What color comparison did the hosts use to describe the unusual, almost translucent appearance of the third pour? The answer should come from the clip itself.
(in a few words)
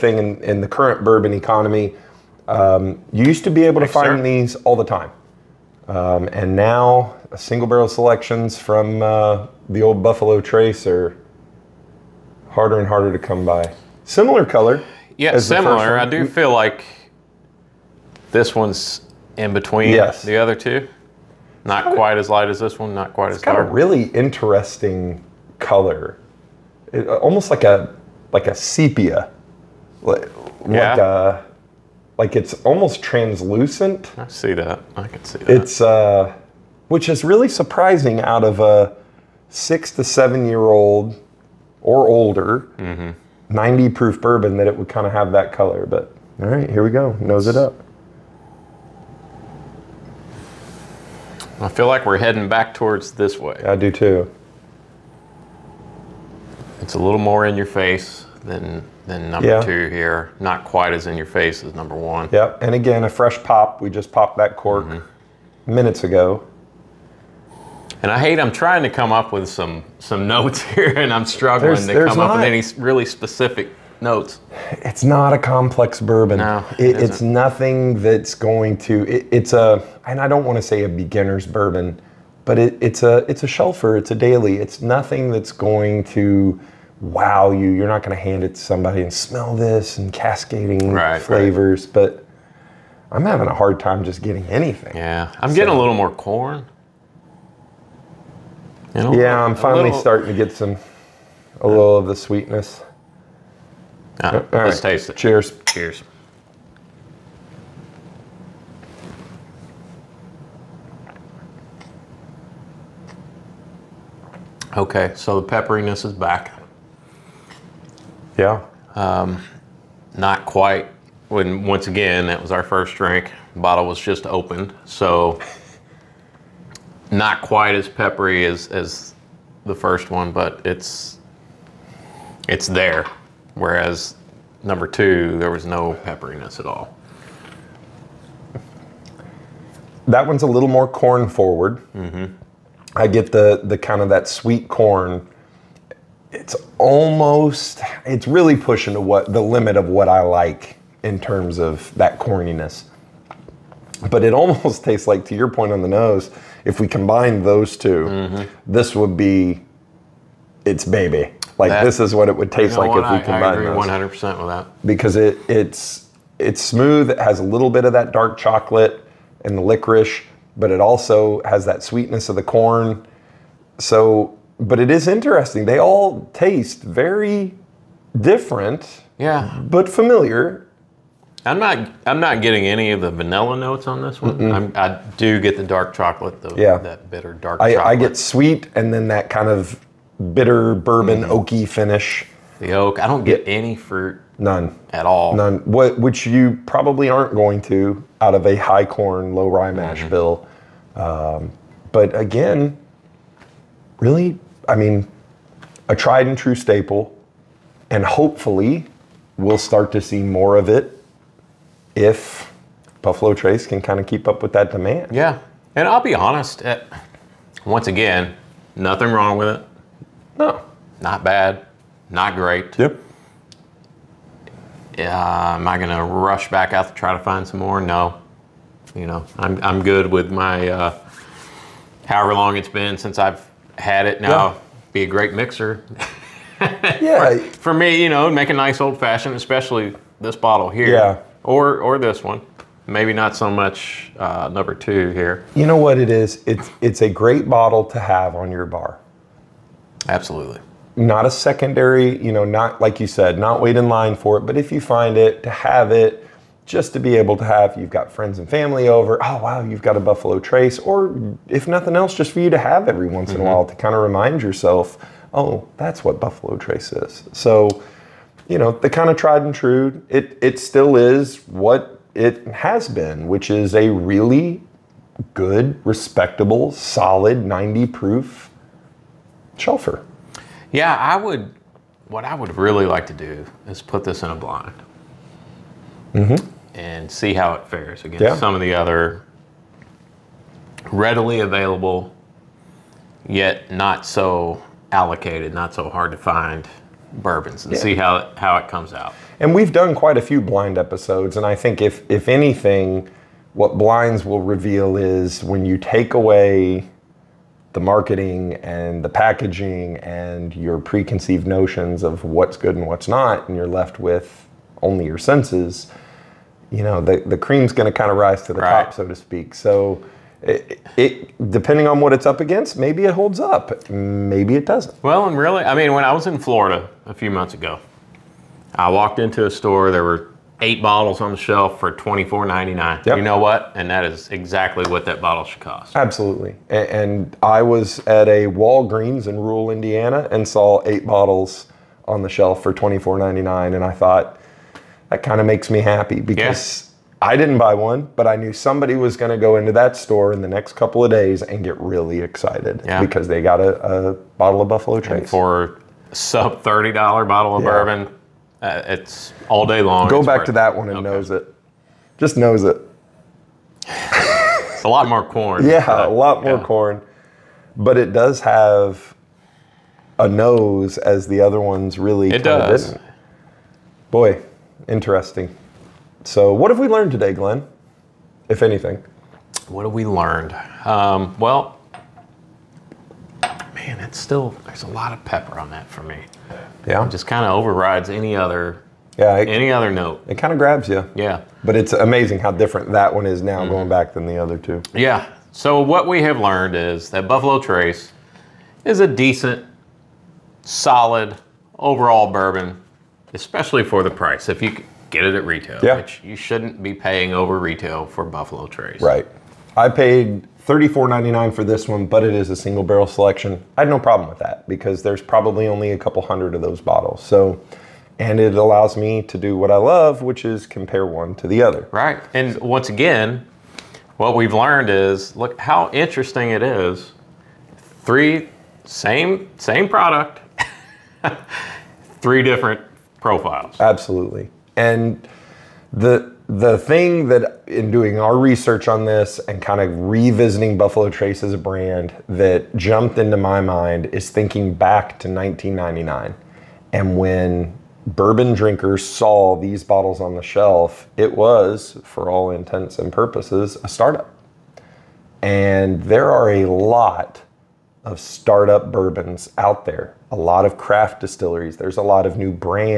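Sepia.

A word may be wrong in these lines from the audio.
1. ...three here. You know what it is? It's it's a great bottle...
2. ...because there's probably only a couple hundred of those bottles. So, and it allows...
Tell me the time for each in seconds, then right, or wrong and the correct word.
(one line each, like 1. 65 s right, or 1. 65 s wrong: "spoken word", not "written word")
1. 244 s wrong: "two", not "three"
2. 414 s right.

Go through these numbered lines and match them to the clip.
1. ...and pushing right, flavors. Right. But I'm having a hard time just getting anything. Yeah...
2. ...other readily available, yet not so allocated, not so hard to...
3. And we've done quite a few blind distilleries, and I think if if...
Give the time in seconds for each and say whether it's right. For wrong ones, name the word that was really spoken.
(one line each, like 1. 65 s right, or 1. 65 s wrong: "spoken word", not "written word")
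1. 89 s wrong: "cascading", not "pushing"
2. 288 s right
3. 299 s wrong: "episodes", not "distilleries".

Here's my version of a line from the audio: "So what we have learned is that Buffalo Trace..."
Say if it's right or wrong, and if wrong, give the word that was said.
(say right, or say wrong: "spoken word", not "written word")
right.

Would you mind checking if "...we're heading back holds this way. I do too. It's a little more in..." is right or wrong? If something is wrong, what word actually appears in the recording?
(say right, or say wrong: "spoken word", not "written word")
wrong: "towards", not "holds".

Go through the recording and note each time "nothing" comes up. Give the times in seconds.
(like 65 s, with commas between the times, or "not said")
77 s, 84 s, 218 s, 261 s.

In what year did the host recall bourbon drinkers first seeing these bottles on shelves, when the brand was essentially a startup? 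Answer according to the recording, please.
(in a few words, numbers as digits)
1999.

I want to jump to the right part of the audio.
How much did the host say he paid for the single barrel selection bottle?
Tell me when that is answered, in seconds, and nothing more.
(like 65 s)
410 s.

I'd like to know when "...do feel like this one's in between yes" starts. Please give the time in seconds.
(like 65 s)
16 s.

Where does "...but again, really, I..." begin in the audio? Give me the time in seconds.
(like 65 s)
201 s.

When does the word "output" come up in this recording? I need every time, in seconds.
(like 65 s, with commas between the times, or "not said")
not said.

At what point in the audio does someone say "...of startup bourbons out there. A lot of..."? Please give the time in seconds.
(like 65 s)
458 s.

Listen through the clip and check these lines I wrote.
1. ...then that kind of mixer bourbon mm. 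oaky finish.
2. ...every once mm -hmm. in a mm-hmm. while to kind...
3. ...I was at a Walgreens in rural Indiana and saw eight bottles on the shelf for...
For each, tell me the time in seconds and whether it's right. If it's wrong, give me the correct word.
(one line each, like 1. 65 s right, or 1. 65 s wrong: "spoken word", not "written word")
1. 188 s wrong: "bitter", not "mixer"
2. 262 s right
3. 337 s right.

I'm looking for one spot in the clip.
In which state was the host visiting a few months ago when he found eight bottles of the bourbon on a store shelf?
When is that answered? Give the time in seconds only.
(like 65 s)
326 s.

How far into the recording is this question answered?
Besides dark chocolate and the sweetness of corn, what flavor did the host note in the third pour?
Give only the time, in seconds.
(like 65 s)
169 s.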